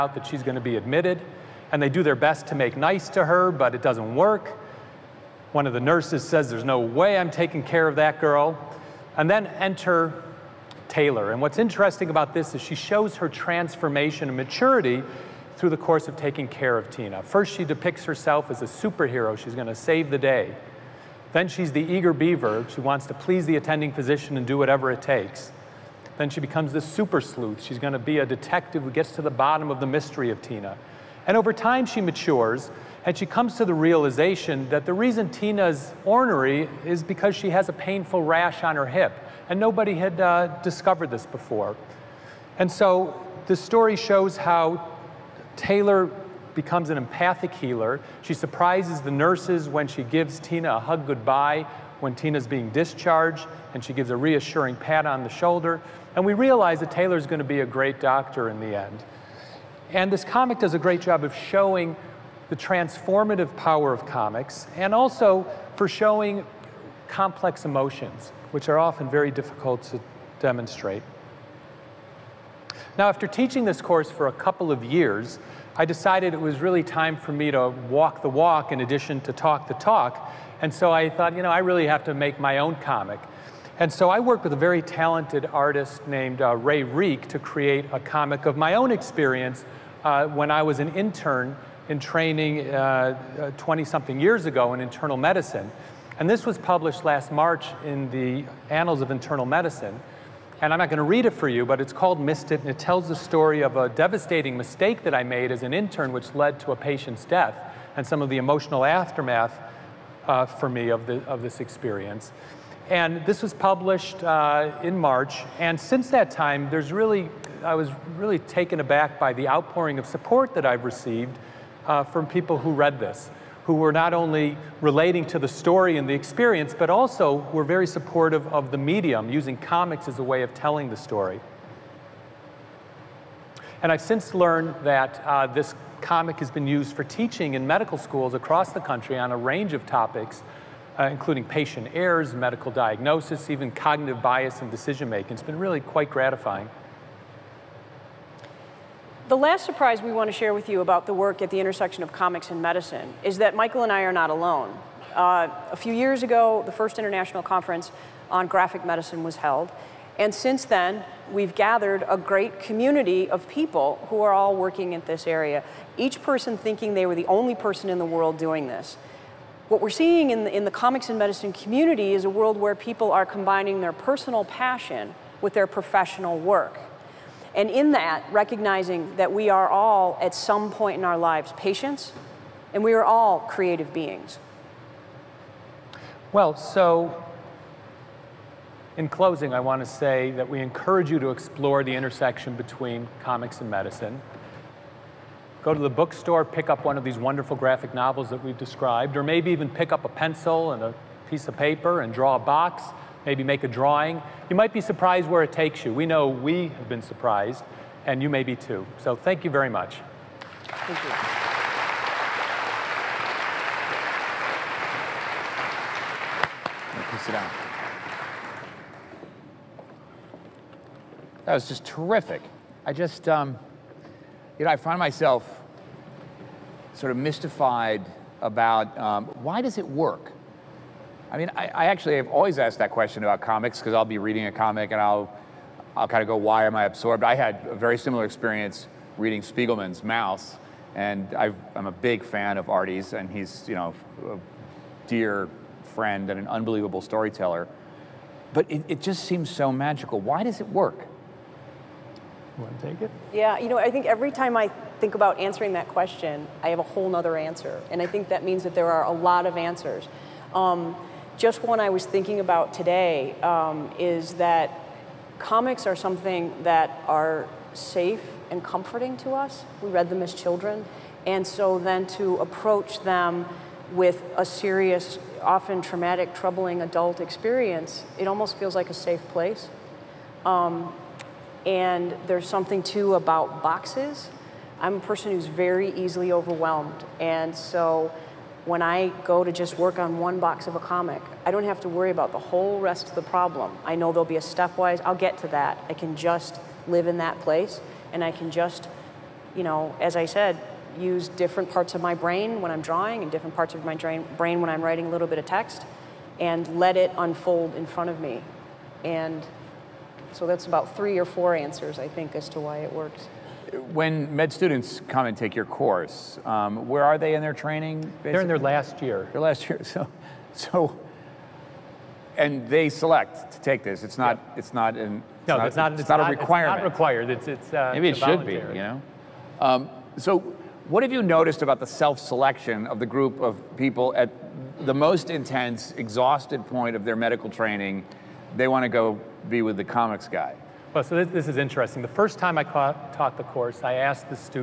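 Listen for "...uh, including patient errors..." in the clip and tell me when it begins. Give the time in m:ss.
2:20.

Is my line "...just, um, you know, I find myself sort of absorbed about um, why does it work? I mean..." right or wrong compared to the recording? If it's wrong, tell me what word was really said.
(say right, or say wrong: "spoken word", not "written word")
wrong: "mystified", not "absorbed".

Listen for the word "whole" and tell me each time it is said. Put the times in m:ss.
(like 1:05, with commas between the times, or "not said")
4:16, 4:52.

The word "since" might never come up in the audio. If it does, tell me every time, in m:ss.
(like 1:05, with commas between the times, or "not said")
1:55, 2:14, 2:40.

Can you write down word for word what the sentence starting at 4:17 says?
And I think that means that there are a lot of answers.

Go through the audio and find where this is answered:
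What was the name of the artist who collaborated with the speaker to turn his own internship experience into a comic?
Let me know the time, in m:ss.
1:26.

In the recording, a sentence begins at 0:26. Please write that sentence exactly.
Then she becomes the super sleuth.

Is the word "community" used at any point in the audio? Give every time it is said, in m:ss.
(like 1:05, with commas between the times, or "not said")
2:42, 2:51.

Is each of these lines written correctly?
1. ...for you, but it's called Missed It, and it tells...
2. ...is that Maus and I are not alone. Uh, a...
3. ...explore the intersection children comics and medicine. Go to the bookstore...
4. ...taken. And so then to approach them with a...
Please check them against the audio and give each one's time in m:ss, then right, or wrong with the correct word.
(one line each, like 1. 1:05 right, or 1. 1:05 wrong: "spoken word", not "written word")
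1. 1:41 right
2. 2:33 wrong: "Michael", not "Maus"
3. 3:11 wrong: "between", not "children"
4. 4:30 wrong: "children", not "taken".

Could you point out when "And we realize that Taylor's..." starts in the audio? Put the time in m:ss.
0:56.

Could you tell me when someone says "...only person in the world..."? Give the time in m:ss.
2:47.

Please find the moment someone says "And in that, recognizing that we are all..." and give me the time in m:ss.
2:57.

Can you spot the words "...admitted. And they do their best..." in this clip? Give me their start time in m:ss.
0:00.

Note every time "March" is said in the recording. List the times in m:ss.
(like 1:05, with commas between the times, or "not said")
1:37, 1:54.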